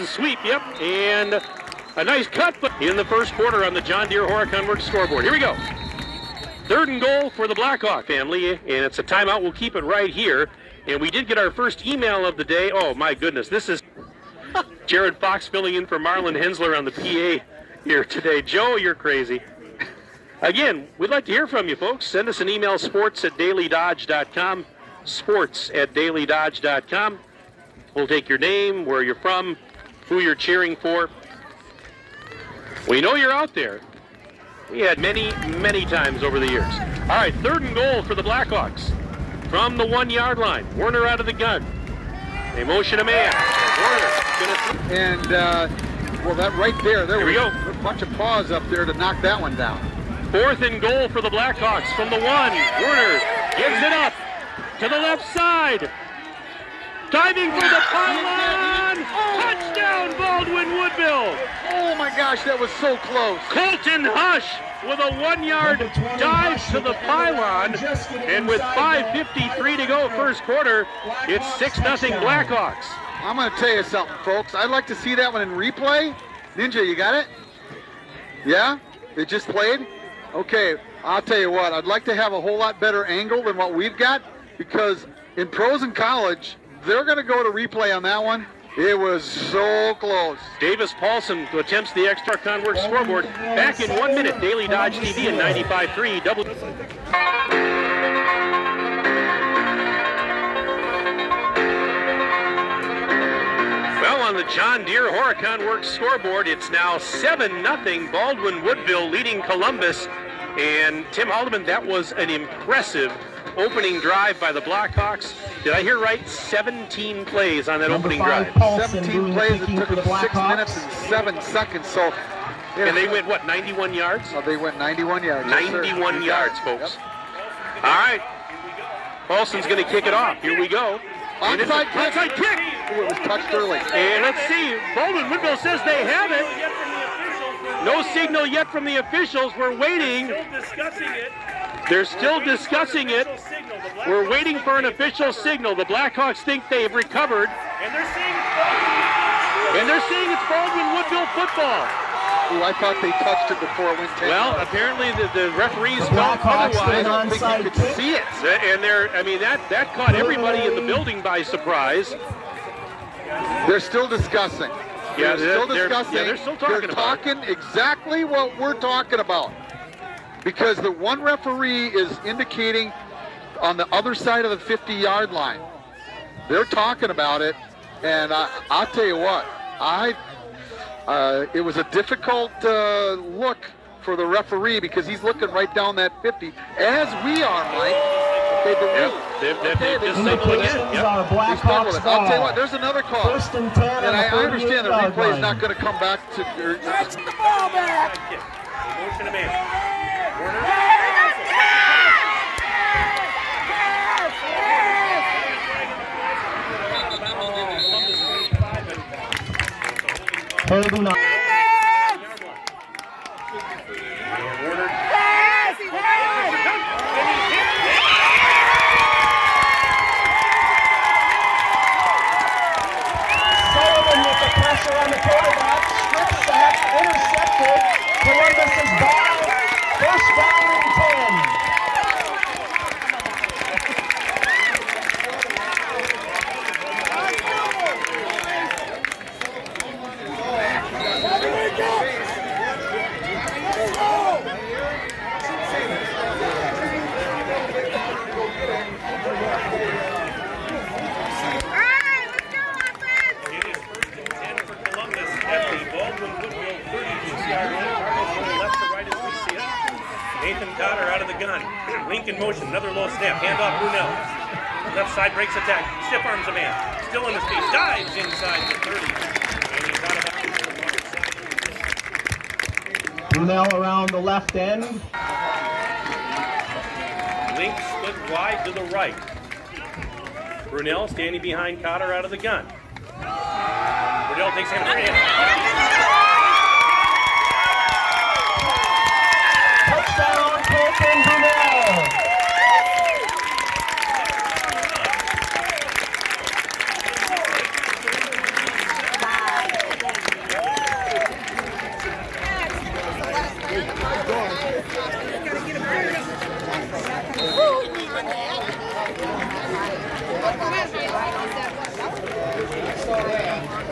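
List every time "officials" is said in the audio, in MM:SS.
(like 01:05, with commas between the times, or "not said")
02:18, 02:24.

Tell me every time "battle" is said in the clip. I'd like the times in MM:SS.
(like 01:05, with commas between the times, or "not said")
not said.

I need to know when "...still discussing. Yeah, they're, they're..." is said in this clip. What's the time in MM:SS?
02:43.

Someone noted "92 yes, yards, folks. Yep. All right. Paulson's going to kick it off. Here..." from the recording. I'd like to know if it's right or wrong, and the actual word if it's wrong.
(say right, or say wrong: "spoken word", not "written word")
wrong: "91", not "92".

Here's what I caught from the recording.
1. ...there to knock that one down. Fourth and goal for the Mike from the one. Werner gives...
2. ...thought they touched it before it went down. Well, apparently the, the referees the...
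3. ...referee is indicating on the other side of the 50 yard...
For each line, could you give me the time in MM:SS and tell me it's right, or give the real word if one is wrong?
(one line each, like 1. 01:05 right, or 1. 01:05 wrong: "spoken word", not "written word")
1. 00:48 wrong: "Blackhawks", not "Mike"
2. 02:32 right
3. 02:51 right.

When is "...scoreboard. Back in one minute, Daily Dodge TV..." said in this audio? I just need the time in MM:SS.
01:32.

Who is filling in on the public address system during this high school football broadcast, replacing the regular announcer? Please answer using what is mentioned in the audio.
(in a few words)
Jared Fox.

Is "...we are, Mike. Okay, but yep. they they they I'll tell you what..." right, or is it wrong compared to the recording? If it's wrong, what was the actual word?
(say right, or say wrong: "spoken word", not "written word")
right.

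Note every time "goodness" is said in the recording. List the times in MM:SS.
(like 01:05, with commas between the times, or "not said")
00:13.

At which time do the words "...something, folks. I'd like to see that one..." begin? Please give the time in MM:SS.
01:13.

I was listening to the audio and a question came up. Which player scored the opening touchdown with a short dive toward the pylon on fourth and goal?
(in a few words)
Colton Hush.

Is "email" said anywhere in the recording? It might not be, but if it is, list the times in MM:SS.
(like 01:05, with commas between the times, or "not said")
00:11, 00:22.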